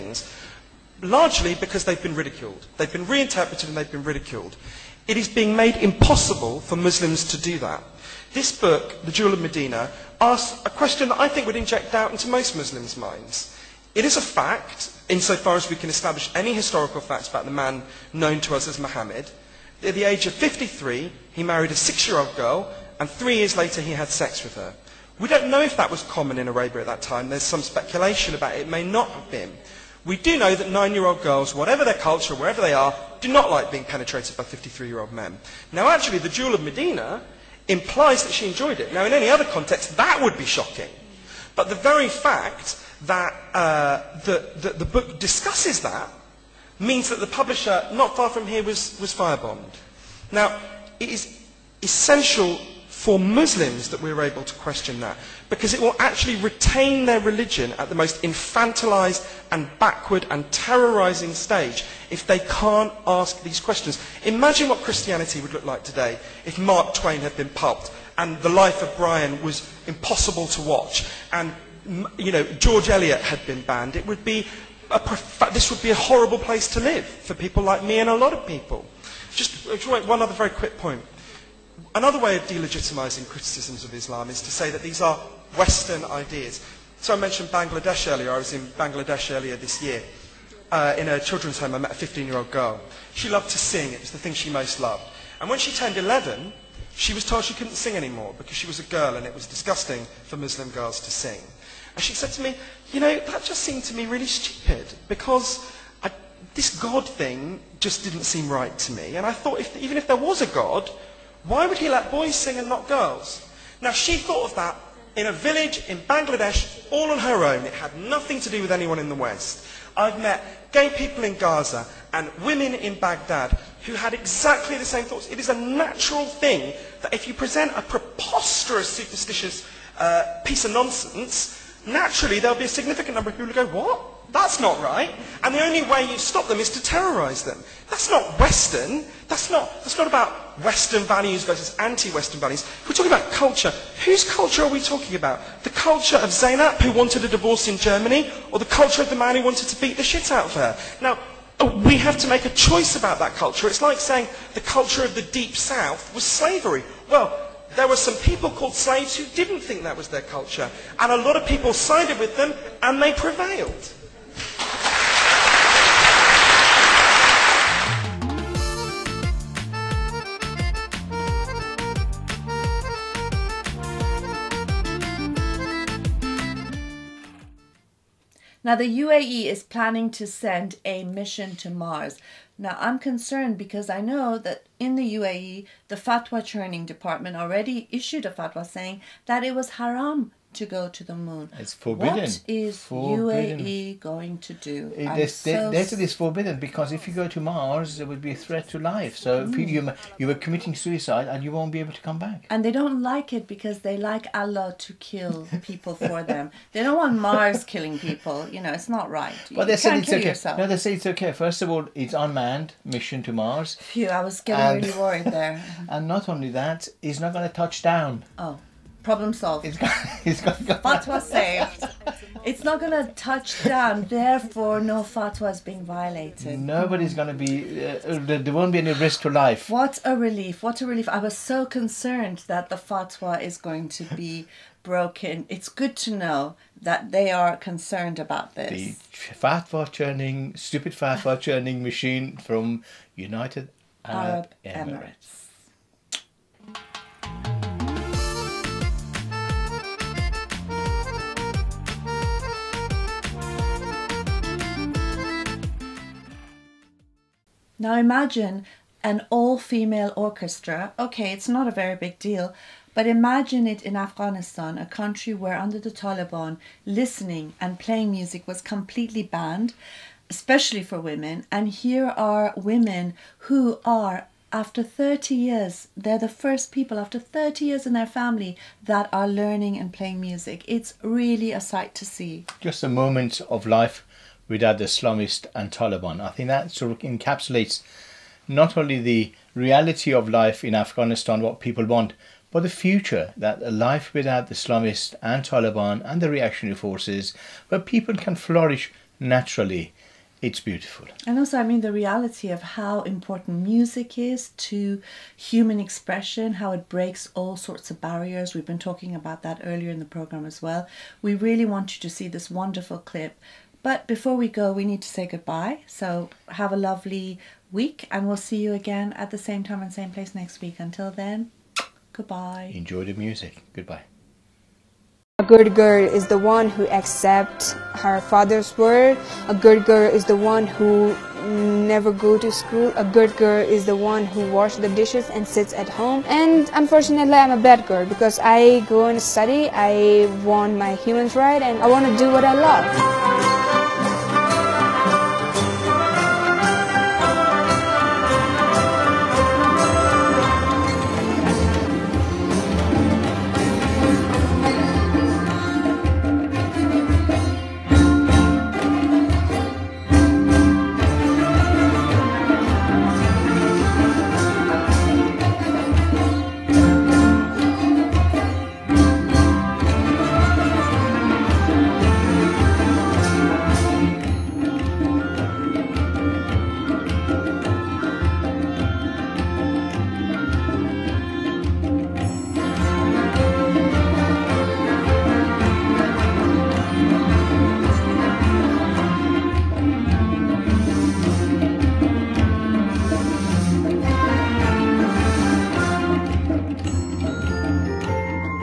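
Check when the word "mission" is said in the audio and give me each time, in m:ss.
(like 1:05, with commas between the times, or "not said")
3:01, 3:32.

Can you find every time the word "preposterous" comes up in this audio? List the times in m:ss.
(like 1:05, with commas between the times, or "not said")
2:07.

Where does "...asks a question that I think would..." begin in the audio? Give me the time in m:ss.
0:10.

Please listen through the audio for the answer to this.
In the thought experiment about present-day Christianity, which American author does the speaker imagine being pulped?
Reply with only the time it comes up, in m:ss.
1:06.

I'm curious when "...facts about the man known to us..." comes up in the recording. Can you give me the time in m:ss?
0:17.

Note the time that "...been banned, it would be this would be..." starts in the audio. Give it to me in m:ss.
1:13.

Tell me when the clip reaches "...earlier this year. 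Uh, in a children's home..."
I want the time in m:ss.
1:29.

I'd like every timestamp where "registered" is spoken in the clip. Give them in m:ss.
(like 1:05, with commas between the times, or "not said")
not said.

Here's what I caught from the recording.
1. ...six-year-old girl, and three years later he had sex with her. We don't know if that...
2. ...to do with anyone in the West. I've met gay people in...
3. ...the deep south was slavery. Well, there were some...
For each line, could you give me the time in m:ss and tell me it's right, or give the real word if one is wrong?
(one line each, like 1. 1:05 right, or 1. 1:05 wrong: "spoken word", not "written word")
1. 0:21 right
2. 1:58 right
3. 2:35 right.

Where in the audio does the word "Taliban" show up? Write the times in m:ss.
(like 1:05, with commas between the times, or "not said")
4:25, 4:45, 4:55.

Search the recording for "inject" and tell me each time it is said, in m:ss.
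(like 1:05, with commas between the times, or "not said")
0:11.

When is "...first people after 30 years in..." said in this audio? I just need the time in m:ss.
4:36.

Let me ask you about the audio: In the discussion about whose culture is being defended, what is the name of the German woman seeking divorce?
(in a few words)
Zainab.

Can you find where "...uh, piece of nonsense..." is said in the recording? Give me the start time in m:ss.
2:09.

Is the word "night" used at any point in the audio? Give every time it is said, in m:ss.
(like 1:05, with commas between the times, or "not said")
not said.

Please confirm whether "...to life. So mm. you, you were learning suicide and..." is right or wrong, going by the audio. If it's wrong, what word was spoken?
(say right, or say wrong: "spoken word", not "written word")
wrong: "committing", not "learning".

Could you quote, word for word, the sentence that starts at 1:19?
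Just uh, one other very quick point.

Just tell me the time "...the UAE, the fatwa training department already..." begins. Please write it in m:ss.
3:04.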